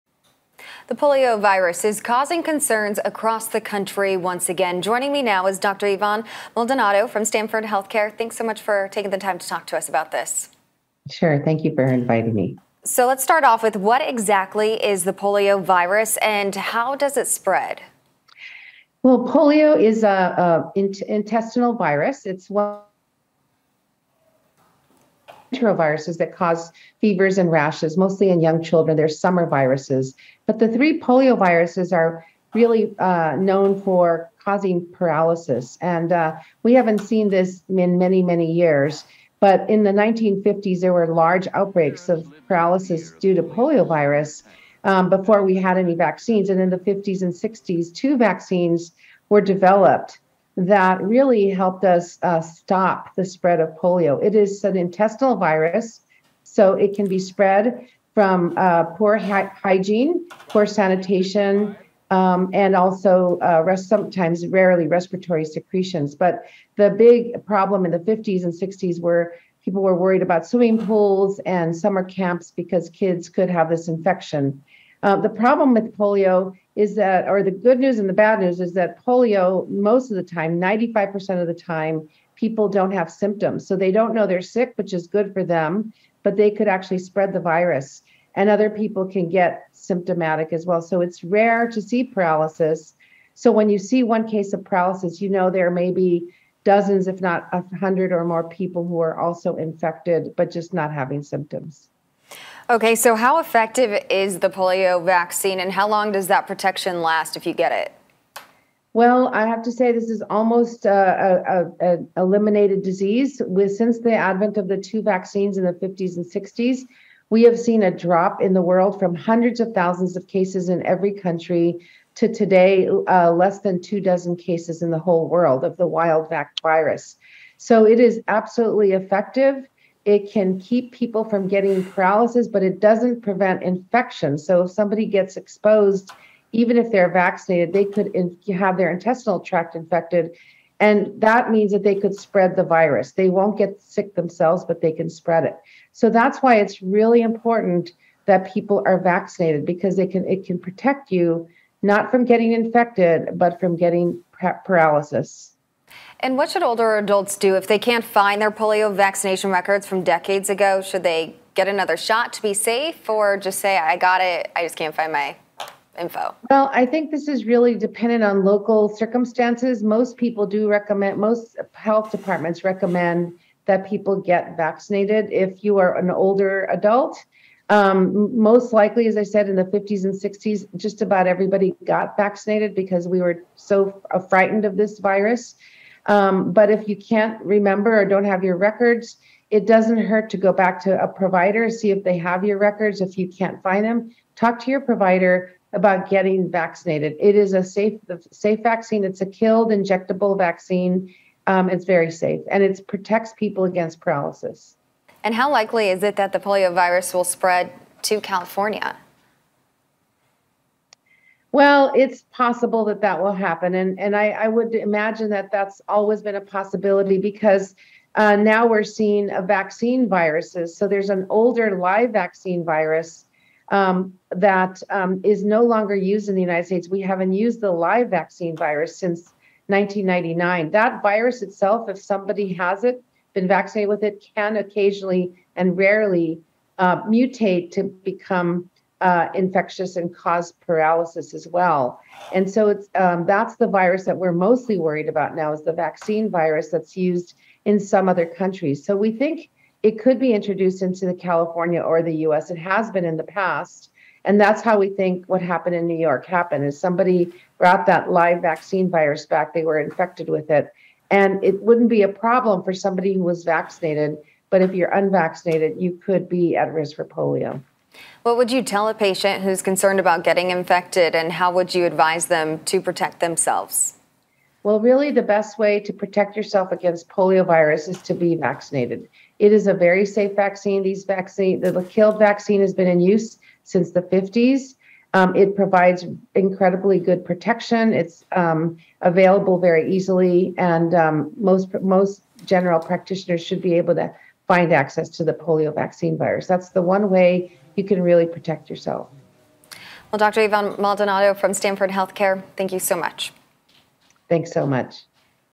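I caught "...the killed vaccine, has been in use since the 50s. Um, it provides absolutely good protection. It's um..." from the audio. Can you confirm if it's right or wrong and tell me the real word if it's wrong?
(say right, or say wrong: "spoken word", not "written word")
wrong: "incredibly", not "absolutely".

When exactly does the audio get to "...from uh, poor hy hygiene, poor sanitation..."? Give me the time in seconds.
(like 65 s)
58 s.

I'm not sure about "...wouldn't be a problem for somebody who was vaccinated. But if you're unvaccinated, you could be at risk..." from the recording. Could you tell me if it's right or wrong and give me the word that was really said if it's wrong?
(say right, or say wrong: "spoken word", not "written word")
right.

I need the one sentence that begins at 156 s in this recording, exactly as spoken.
And what should older adults do if they can't find their polio vaccination records from decades ago?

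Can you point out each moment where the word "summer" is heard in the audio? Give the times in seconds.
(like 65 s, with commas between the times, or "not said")
29 s, 71 s.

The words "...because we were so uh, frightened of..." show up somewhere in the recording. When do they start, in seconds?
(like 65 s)
182 s.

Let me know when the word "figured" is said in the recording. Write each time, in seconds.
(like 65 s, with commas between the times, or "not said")
not said.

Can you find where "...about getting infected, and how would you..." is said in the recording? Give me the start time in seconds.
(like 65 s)
269 s.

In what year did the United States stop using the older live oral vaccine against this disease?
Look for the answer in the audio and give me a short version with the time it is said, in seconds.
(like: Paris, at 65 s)
1999, at 229 s.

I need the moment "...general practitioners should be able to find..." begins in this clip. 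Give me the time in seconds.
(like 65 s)
292 s.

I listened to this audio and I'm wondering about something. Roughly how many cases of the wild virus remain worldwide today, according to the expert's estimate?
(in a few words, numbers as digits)
less than 2 dozen.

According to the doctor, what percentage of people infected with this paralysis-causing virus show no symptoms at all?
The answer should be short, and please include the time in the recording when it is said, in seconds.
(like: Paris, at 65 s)
95%, at 80 s.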